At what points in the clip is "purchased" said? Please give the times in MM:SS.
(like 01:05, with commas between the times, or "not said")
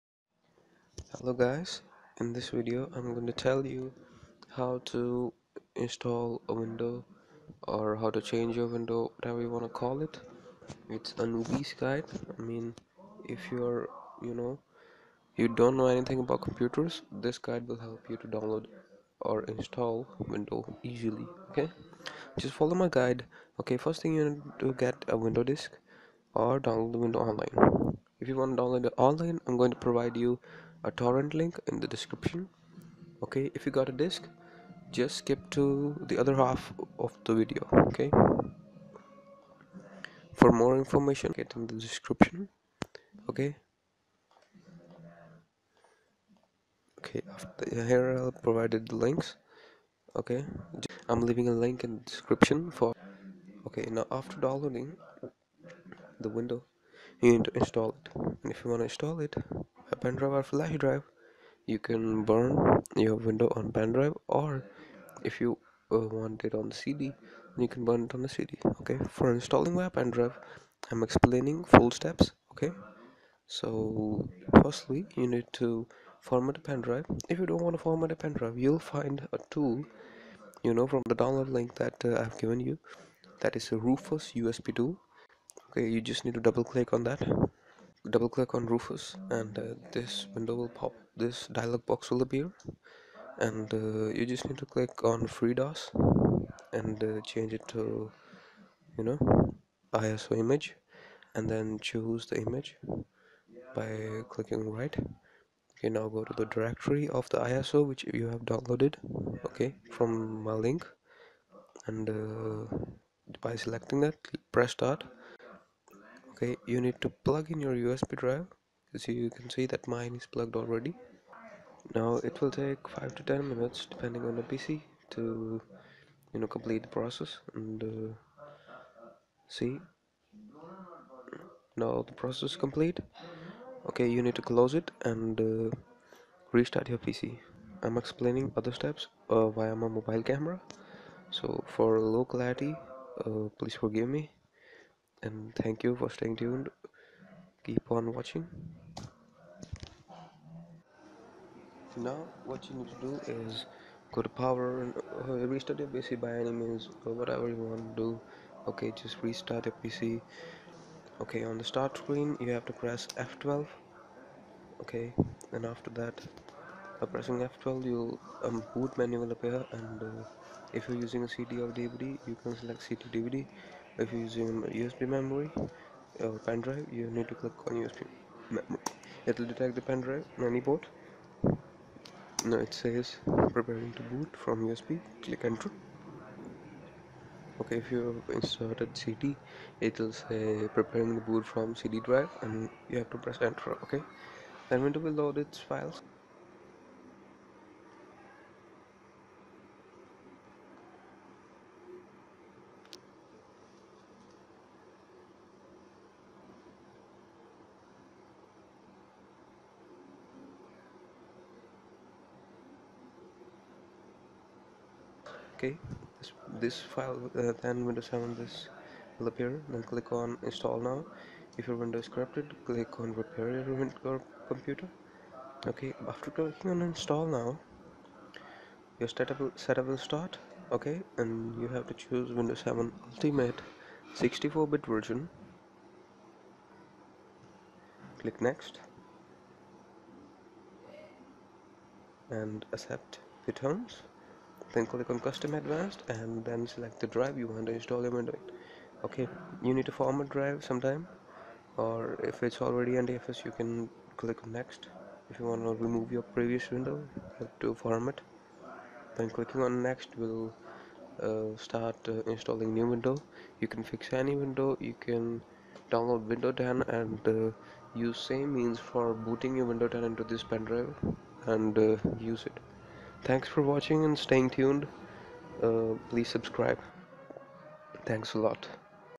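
not said.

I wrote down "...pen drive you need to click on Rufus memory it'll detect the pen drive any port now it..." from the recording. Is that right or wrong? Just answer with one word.
wrong.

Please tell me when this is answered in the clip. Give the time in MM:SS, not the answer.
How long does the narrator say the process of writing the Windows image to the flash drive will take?
02:02.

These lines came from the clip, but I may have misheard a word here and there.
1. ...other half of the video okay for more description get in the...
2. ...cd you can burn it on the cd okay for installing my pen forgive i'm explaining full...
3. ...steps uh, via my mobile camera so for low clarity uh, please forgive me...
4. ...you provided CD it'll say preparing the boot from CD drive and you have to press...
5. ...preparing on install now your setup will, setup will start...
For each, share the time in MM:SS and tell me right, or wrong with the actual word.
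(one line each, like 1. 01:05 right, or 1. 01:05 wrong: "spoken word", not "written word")
1. 00:36 wrong: "information", not "description"
2. 01:06 wrong: "drive", not "forgive"
3. 02:18 right
4. 03:07 wrong: "inserted", not "provided"
5. 03:46 wrong: "clicking", not "preparing".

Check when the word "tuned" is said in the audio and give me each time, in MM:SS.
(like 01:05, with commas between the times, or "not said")
02:26, 04:34.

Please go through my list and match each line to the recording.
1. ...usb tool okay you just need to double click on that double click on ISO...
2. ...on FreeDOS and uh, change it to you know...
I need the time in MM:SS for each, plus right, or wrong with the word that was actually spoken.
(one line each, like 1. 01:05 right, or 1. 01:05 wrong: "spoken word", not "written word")
1. 01:24 wrong: "Rufus", not "ISO"
2. 01:35 right.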